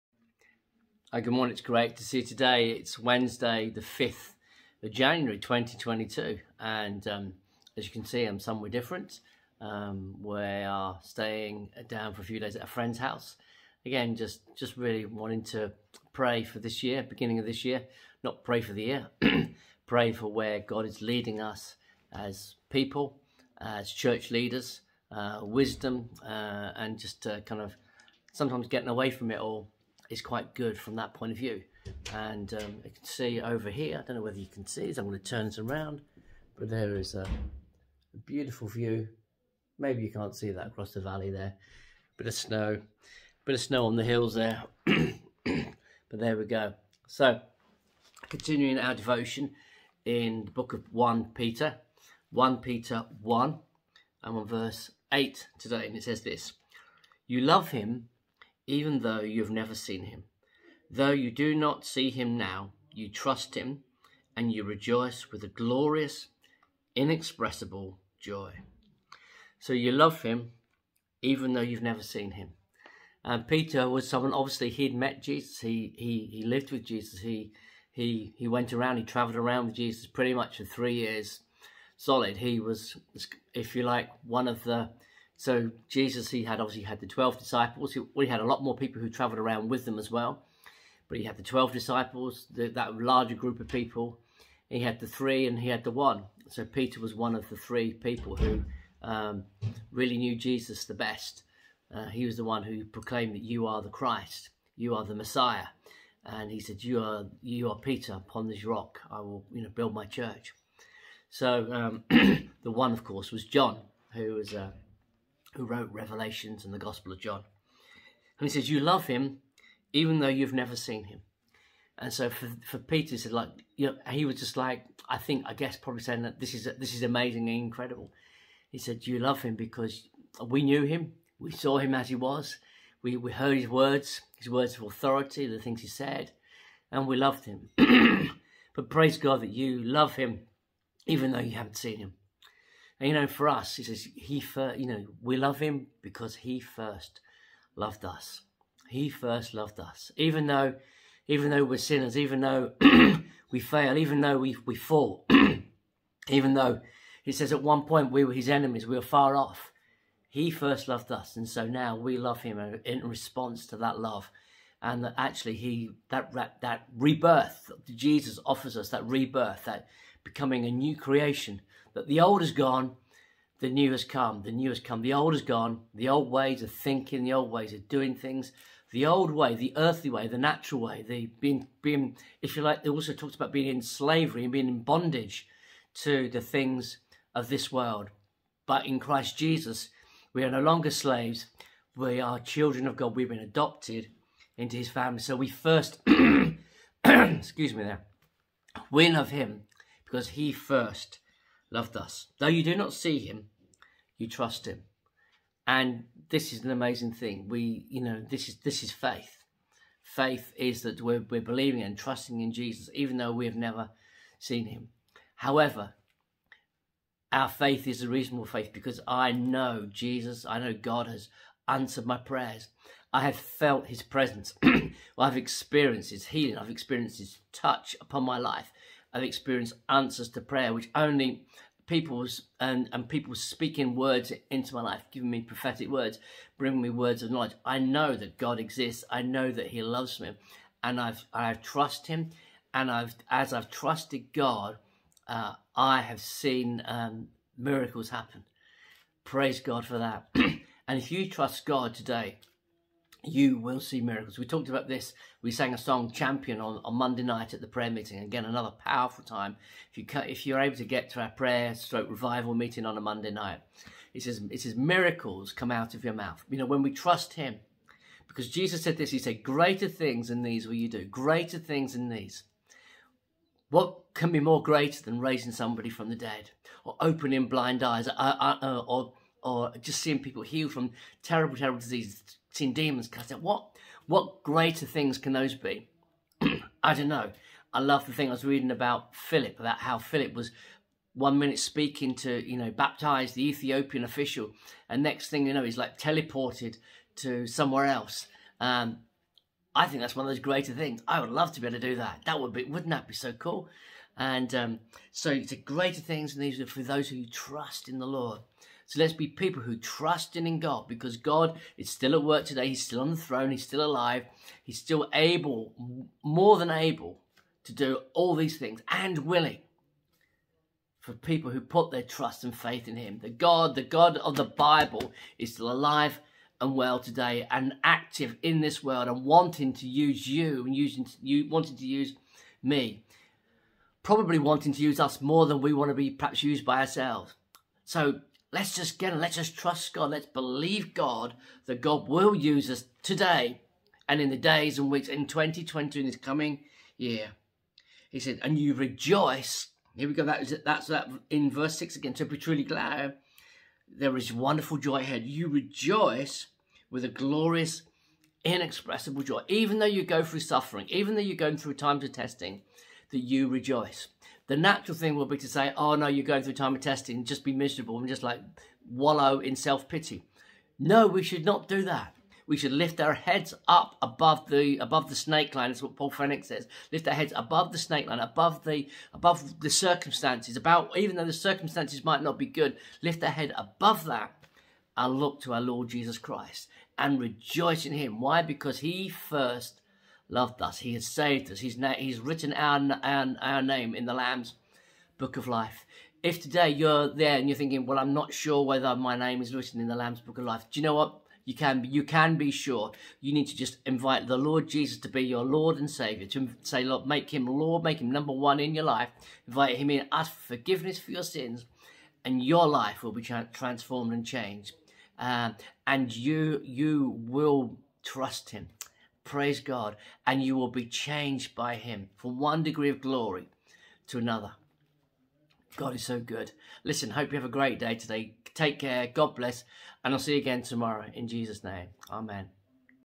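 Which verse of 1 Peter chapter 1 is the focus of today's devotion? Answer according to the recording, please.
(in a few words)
8.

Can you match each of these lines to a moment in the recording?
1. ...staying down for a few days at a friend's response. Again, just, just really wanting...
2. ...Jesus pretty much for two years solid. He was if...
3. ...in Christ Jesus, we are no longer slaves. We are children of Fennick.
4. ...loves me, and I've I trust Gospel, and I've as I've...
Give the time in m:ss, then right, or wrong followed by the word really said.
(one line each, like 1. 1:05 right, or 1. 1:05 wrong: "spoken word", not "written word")
1. 0:11 wrong: "house", not "response"
2. 1:19 wrong: "three", not "two"
3. 3:08 wrong: "God", not "Fennick"
4. 3:59 wrong: "Him", not "Gospel".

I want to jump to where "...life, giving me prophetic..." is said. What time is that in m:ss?
3:54.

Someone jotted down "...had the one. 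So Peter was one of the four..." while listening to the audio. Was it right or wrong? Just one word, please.
wrong.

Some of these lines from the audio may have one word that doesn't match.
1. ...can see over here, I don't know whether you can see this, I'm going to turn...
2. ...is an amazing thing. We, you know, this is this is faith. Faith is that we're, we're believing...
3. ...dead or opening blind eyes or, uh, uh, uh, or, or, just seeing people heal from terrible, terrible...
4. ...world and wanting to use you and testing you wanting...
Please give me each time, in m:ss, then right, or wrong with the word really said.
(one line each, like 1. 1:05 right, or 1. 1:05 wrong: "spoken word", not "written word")
1. 0:32 right
2. 3:26 right
3. 4:36 right
4. 5:28 wrong: "using", not "testing".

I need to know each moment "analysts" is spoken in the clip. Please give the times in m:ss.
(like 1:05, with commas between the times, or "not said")
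not said.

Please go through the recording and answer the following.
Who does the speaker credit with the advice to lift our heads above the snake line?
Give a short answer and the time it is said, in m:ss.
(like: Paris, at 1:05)
Paul Fennick, at 6:15.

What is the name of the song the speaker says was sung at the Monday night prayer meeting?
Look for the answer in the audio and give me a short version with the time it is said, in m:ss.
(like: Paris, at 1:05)
Champion, at 4:16.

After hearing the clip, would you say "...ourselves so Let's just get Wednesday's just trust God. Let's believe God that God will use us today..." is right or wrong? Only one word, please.
wrong.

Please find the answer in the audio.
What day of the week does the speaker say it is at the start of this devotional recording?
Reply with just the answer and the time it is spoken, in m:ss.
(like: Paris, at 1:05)
Wednesday, at 0:02.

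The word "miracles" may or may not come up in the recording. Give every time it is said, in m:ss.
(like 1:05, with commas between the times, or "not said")
4:07, 4:14, 4:24.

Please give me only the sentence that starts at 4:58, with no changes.
Um, I think that's one of those greater things.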